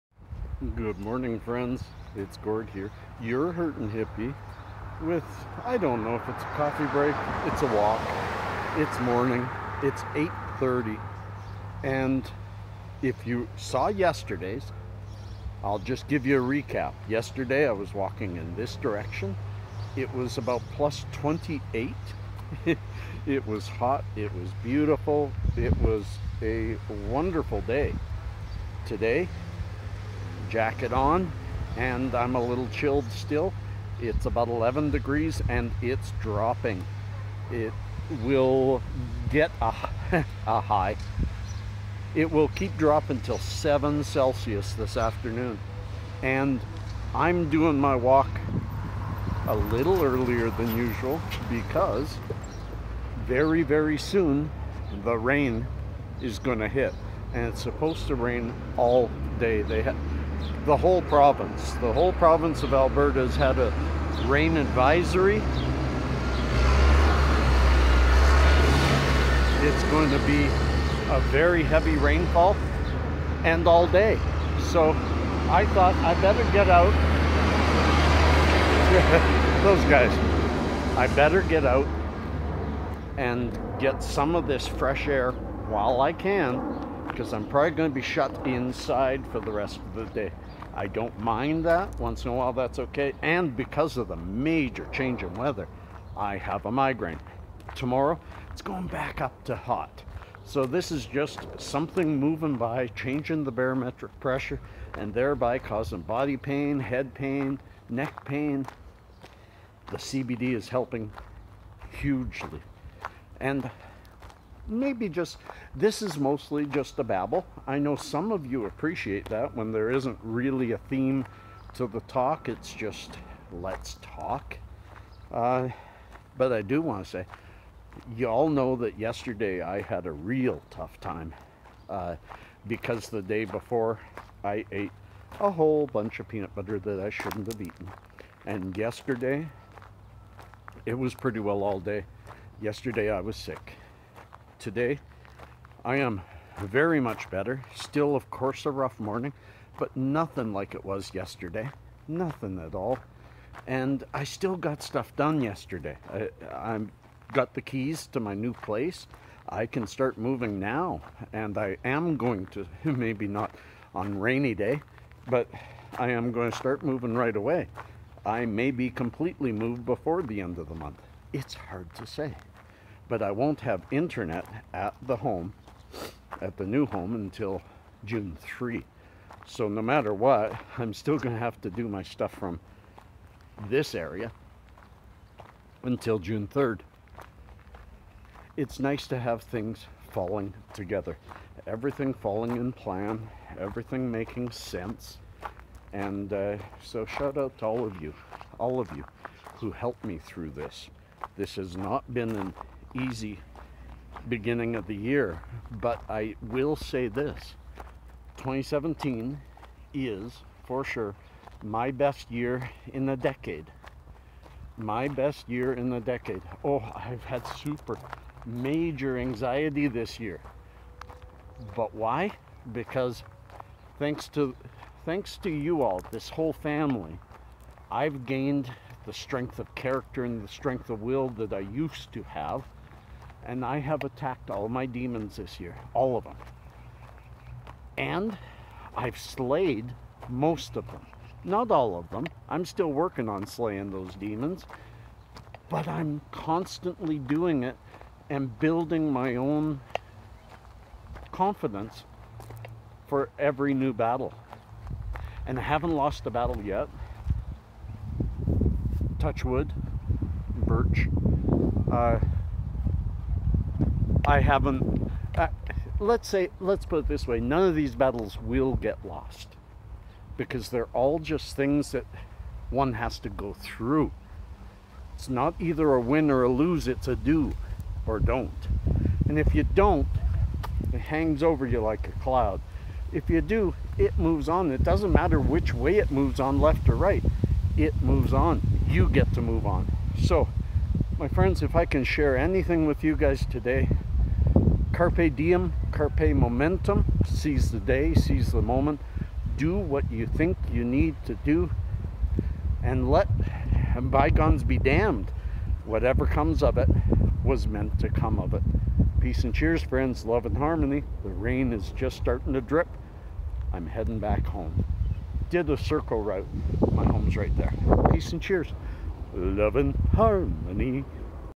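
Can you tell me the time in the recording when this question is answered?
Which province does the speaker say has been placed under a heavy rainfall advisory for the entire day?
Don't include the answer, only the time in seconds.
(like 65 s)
62 s.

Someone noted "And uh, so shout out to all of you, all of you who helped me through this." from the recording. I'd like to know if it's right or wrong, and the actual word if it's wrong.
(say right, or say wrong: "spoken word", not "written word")
right.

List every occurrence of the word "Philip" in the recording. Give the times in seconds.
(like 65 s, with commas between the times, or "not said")
not said.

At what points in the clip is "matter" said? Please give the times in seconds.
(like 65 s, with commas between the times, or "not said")
179 s, 285 s.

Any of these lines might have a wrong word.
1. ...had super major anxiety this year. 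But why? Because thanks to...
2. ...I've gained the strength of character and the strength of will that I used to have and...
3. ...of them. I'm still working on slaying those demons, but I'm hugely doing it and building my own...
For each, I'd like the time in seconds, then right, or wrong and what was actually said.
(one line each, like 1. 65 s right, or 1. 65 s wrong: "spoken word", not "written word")
1. 217 s right
2. 227 s right
3. 241 s wrong: "constantly", not "hugely".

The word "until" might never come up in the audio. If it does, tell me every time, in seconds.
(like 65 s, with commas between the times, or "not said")
177 s, 185 s.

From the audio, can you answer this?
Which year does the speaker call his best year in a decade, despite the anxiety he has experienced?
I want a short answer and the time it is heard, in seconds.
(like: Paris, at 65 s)
2017, at 208 s.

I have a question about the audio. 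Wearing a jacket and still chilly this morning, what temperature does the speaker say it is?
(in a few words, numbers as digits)
11 degrees.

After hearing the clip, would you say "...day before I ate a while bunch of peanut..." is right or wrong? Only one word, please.
wrong.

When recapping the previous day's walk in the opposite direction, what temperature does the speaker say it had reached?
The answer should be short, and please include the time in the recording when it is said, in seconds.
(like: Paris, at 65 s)
plus 28, at 20 s.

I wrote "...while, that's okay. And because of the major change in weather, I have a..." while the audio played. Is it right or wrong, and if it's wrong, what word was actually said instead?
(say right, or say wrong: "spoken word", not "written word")
right.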